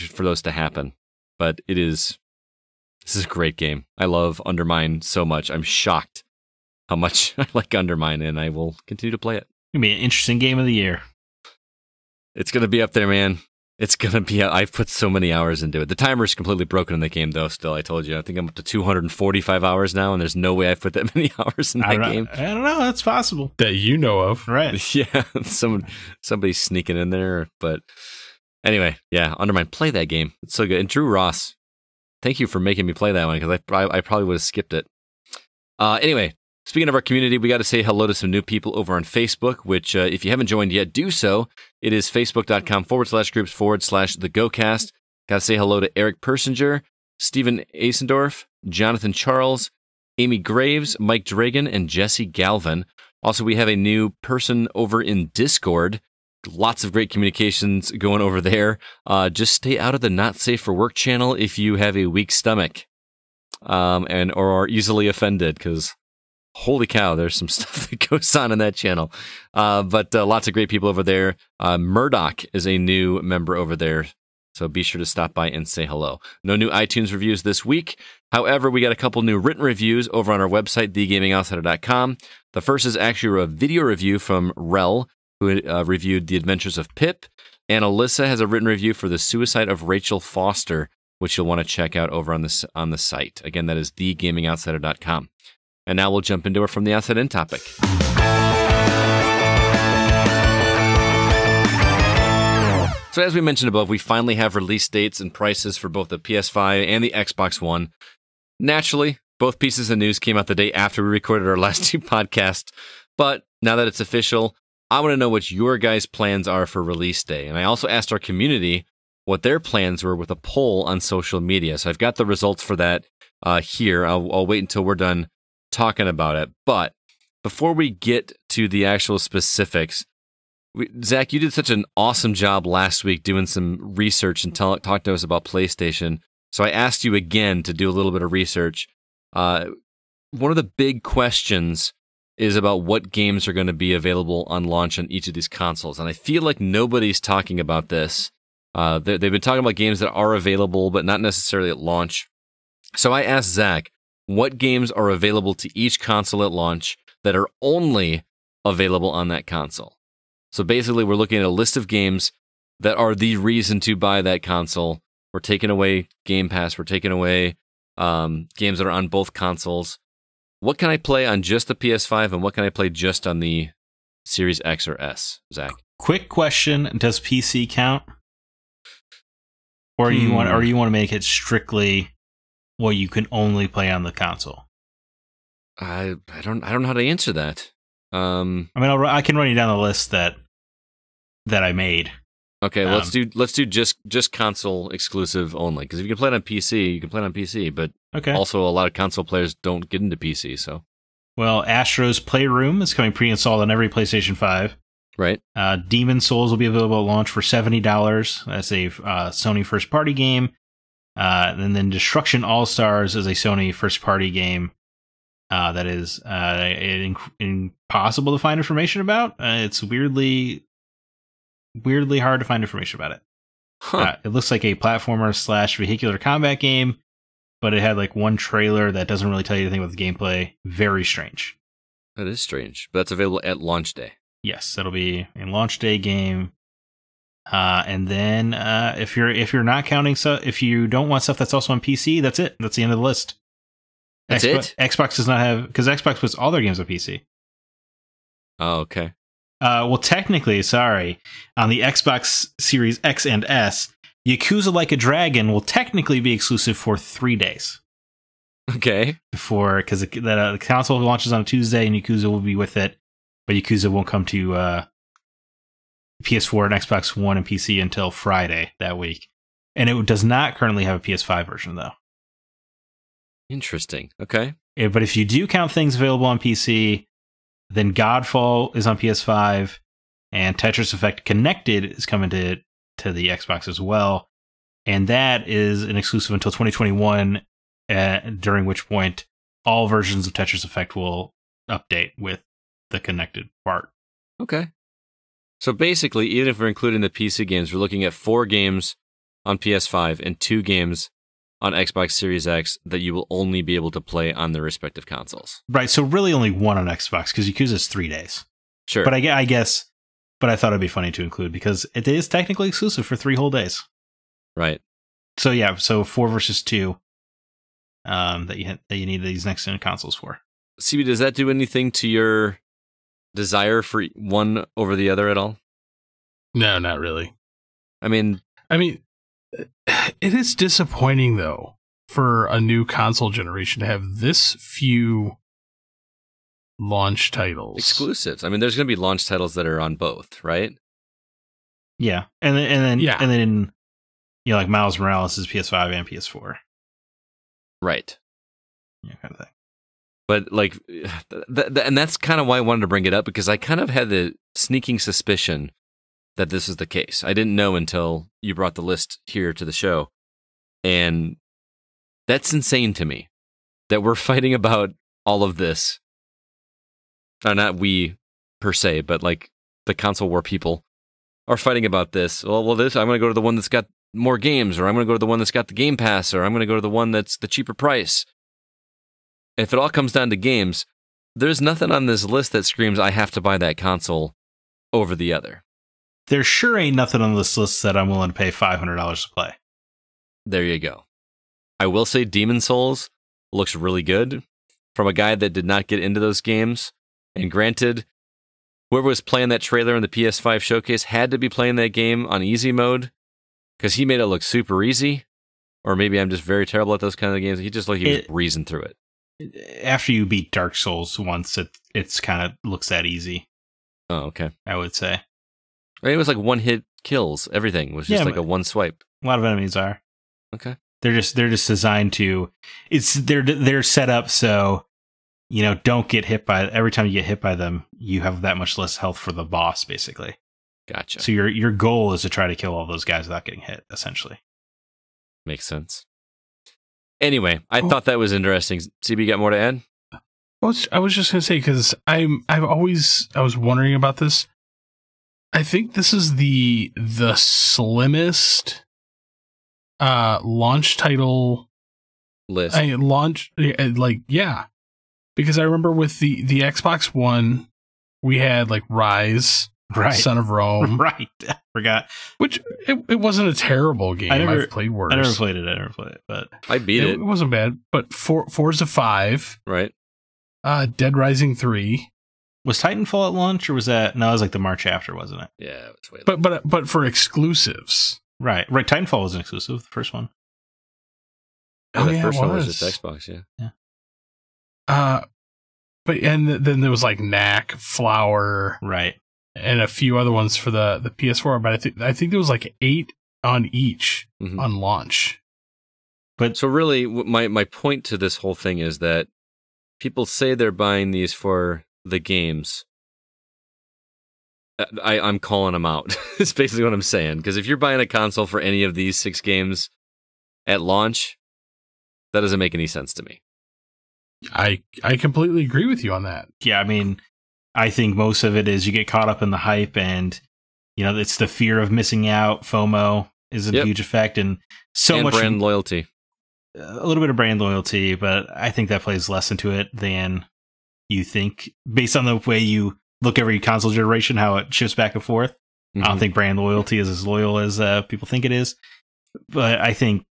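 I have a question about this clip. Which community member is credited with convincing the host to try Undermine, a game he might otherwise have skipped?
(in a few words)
Drew Ross.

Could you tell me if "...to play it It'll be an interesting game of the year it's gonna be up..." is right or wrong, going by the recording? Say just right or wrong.
right.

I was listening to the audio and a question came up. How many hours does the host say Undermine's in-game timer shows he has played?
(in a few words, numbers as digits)
245.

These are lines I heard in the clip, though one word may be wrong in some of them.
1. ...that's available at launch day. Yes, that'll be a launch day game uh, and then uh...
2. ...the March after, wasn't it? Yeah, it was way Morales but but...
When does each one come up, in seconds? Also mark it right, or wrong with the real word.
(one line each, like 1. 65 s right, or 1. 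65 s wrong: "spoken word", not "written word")
1. 232 s right
2. 474 s wrong: "But", not "Morales".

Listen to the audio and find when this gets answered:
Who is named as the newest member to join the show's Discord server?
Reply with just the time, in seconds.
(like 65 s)
71 s.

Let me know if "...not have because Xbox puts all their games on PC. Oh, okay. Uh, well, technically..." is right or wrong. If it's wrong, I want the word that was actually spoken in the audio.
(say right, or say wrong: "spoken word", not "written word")
right.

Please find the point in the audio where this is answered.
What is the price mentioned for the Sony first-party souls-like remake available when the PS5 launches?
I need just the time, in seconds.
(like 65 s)
207 s.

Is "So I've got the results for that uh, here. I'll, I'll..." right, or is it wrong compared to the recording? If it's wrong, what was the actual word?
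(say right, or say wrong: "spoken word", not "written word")
right.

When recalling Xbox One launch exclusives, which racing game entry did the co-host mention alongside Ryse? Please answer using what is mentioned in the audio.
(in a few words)
Forza 5.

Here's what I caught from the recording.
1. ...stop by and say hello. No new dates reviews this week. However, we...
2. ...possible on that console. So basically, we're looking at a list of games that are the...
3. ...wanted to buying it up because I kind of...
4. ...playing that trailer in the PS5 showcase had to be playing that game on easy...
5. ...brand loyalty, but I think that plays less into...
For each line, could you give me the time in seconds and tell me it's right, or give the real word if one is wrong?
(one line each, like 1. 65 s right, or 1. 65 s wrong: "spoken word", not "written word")
1. 75 s wrong: "iTunes", not "dates"
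2. 158 s wrong: "available", not "possible"
3. 352 s wrong: "bring", not "buying"
4. 399 s right
5. 527 s right.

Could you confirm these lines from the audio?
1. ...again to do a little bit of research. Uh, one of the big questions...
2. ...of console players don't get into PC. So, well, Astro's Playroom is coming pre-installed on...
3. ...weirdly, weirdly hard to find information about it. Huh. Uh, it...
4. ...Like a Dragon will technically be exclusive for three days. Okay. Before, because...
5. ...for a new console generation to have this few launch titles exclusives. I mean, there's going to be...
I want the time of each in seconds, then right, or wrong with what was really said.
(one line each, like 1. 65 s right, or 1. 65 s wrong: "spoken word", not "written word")
1. 137 s right
2. 198 s right
3. 219 s right
4. 254 s right
5. 332 s right.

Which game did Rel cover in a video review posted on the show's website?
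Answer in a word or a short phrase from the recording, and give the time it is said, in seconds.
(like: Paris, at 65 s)
The Adventures of Pip, at 86 s.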